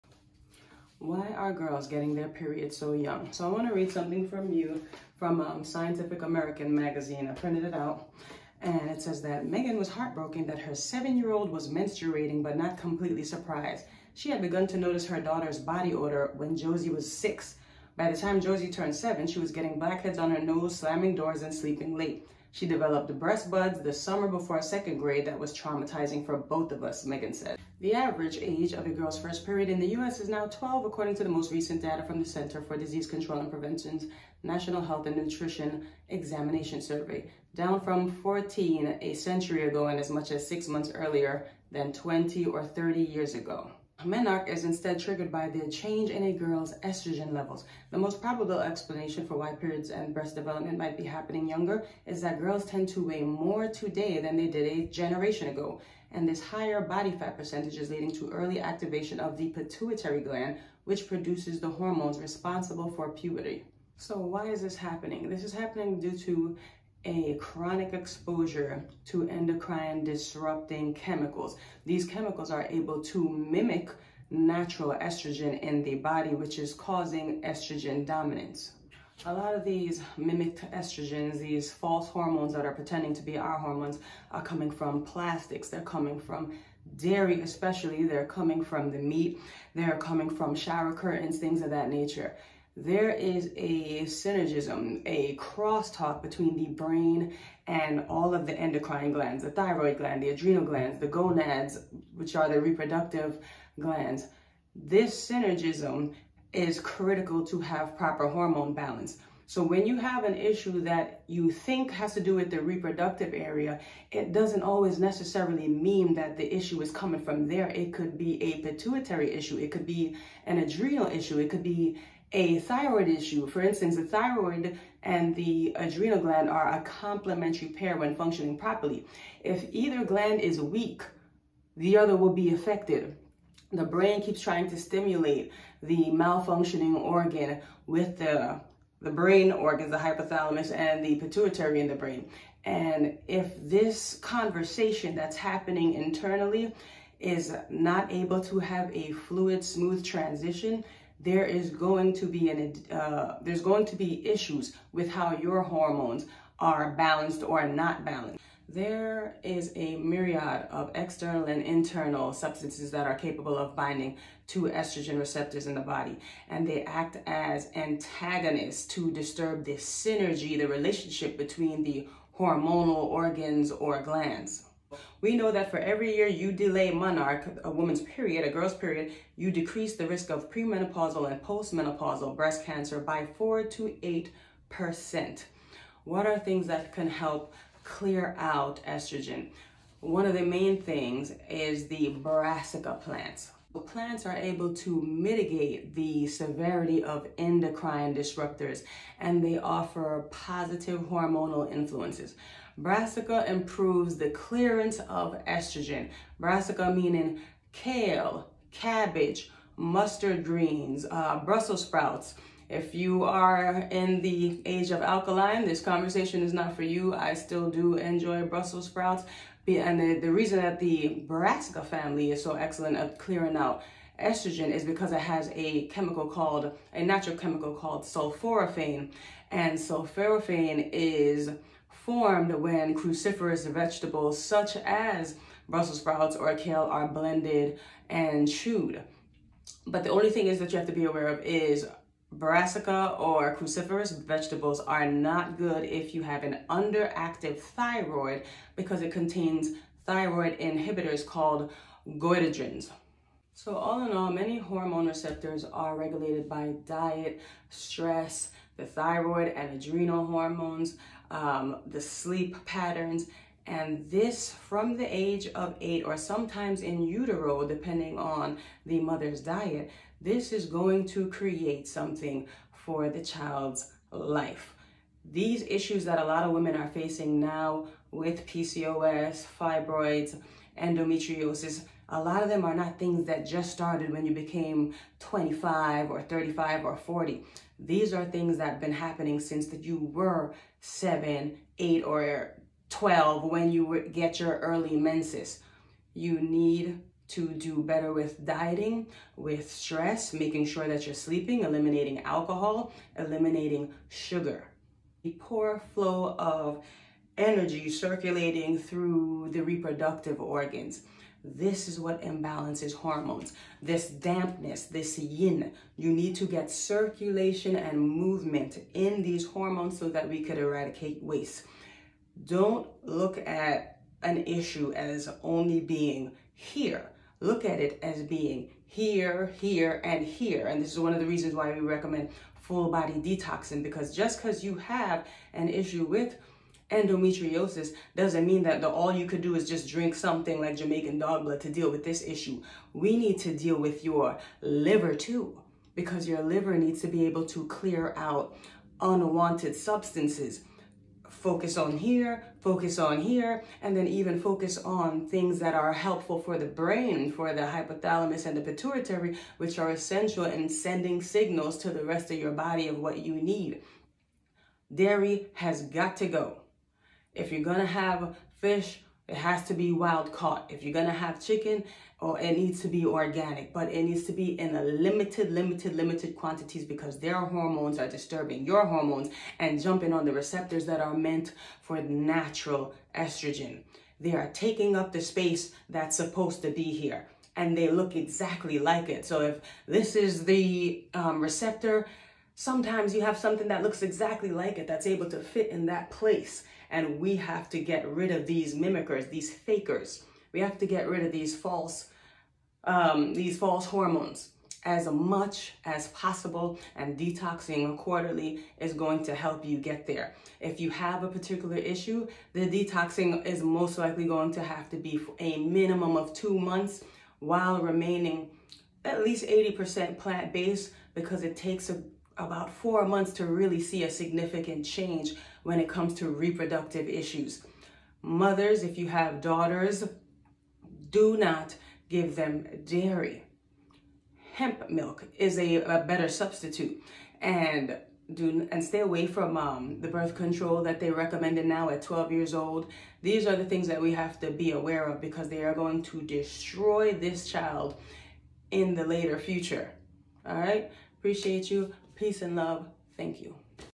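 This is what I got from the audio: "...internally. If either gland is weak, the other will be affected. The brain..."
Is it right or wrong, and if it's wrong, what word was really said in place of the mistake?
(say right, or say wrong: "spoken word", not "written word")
wrong: "properly", not "internally".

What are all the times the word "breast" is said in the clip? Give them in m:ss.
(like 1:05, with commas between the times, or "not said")
0:23, 0:50, 3:02.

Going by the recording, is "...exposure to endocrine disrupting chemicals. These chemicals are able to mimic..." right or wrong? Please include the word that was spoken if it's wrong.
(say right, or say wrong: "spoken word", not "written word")
right.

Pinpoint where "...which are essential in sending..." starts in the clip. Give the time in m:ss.
5:59.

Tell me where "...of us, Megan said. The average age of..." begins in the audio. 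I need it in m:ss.
0:26.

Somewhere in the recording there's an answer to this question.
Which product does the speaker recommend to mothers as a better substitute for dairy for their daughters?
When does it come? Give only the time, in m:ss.
7:14.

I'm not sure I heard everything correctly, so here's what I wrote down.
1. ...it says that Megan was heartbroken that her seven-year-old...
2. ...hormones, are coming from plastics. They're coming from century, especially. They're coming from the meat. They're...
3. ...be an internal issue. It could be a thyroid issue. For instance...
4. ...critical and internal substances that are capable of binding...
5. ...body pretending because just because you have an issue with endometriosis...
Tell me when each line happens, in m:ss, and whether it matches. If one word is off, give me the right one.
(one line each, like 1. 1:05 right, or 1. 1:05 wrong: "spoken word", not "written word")
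1. 0:08 right
2. 1:23 wrong: "dairy", not "century"
3. 1:59 wrong: "adrenal", not "internal"
4. 2:40 wrong: "external", not "critical"
5. 5:32 wrong: "detoxing", not "pretending".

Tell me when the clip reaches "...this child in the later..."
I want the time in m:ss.
7:27.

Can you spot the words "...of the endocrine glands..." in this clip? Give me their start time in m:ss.
1:38.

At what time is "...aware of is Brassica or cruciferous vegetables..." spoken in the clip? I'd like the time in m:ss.
4:01.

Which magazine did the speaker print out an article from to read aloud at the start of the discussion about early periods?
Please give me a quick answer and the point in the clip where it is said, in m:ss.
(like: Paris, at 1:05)
Scientific American, at 0:05.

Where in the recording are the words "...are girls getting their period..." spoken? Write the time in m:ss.
0:01.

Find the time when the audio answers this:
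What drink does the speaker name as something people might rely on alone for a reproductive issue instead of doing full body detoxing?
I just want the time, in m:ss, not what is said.
5:40.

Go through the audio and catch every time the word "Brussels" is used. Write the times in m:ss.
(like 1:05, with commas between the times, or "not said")
3:31, 3:38, 3:55.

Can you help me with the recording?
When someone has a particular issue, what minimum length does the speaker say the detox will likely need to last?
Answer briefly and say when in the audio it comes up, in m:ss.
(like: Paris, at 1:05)
2 months, at 6:56.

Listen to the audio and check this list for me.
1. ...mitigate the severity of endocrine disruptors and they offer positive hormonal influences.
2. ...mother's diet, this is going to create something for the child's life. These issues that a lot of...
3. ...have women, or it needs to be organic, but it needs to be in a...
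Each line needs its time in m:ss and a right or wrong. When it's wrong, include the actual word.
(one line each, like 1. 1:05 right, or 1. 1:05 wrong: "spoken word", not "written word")
1. 3:15 right
2. 4:28 right
3. 6:11 wrong: "chicken", not "women".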